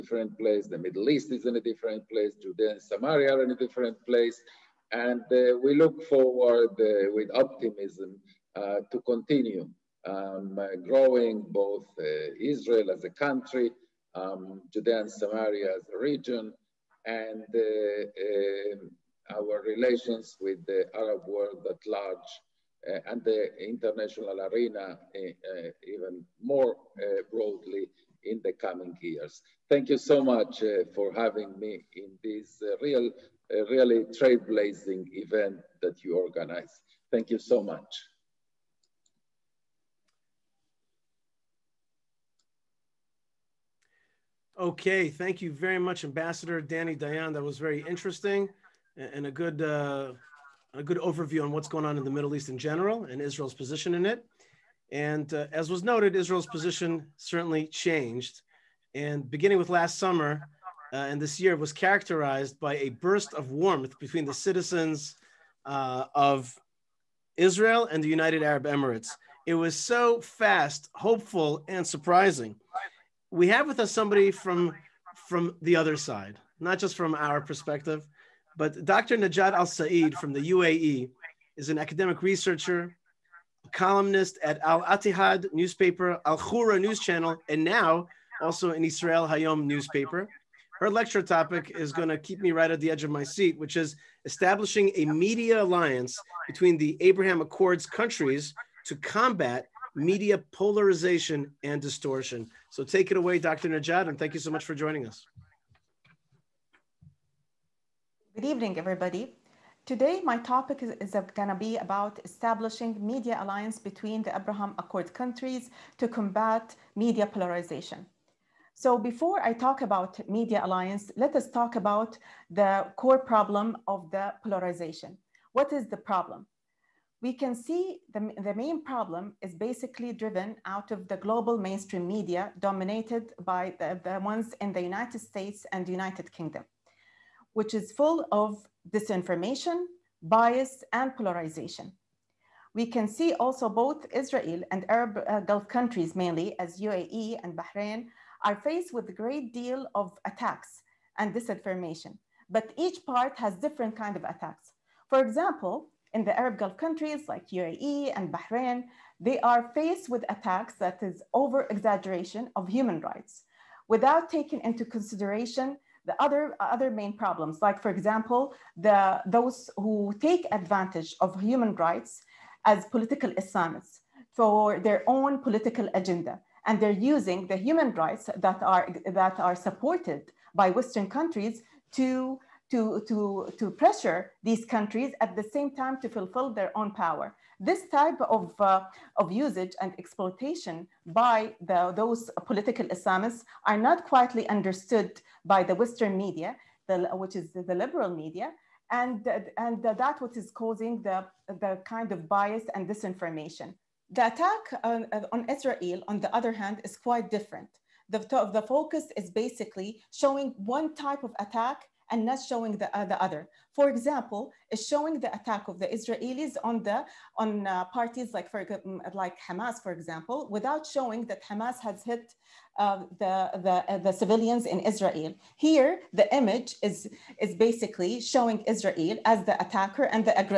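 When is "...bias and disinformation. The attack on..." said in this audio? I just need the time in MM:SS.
03:22.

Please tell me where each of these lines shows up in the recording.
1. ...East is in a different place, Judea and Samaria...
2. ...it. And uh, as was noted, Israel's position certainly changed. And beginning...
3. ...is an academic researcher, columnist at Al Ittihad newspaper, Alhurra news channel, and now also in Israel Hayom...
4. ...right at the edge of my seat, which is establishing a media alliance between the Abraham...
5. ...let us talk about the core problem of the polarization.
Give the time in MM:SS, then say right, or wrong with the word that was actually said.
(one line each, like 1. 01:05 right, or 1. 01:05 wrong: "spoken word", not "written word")
1. 00:01 right
2. 00:54 right
3. 01:21 right
4. 01:32 right
5. 02:01 right.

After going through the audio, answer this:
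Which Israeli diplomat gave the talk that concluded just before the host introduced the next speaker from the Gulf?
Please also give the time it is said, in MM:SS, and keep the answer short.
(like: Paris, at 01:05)
Dani Dayan, at 00:46.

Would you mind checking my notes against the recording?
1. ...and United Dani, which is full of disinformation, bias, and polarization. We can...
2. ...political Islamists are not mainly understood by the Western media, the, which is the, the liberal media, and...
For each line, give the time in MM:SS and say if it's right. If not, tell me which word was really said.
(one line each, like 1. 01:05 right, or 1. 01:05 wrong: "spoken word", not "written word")
1. 02:15 wrong: "Kingdom", not "Dani"
2. 03:12 wrong: "quietly", not "mainly".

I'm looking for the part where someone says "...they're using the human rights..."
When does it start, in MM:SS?
02:56.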